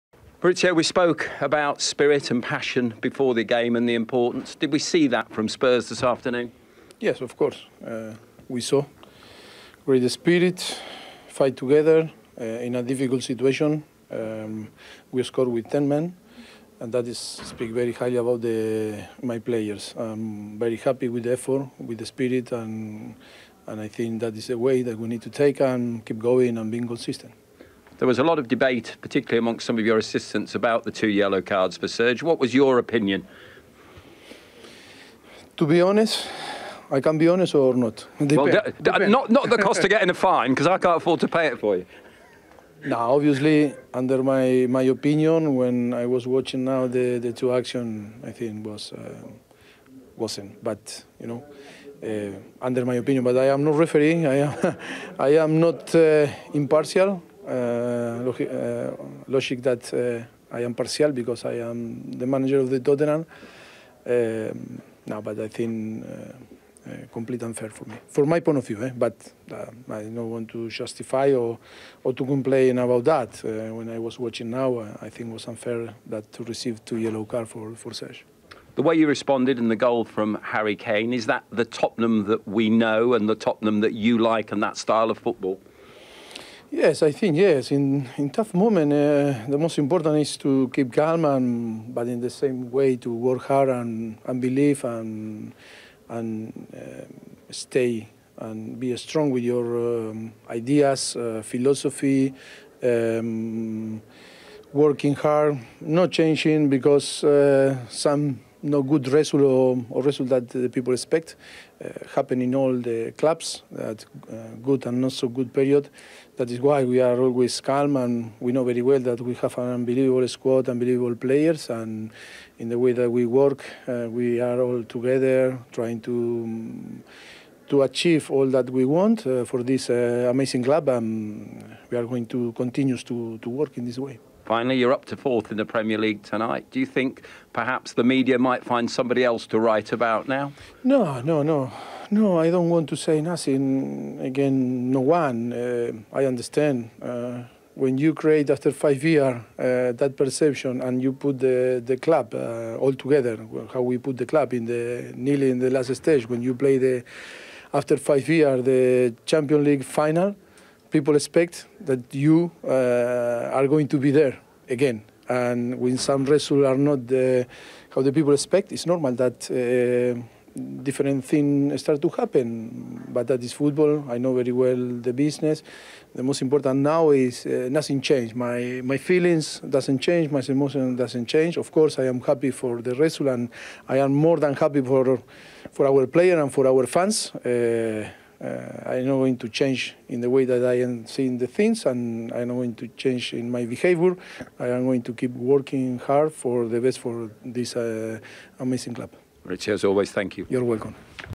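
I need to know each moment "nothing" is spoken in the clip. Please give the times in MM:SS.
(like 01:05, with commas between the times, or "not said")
02:23, 02:57.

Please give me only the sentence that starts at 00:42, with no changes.
Now, obviously, under my, my opinion, when I was watching now the, the two action, I think was uh, wasn't.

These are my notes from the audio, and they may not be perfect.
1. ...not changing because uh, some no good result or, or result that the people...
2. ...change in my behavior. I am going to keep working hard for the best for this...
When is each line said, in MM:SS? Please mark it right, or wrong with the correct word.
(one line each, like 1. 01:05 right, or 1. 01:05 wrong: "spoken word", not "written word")
1. 01:45 right
2. 03:12 right.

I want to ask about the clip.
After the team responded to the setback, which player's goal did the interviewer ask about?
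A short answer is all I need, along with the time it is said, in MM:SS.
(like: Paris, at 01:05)
Harry Kane, at 01:20.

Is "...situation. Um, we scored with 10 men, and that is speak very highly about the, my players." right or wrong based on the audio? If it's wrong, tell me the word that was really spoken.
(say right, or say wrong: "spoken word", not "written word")
right.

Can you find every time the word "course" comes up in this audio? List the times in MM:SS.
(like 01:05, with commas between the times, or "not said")
00:07, 03:01.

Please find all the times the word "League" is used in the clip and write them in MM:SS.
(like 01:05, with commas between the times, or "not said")
02:15, 02:39.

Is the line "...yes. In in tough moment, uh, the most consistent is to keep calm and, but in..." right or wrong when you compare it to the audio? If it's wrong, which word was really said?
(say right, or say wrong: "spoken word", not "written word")
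wrong: "important", not "consistent".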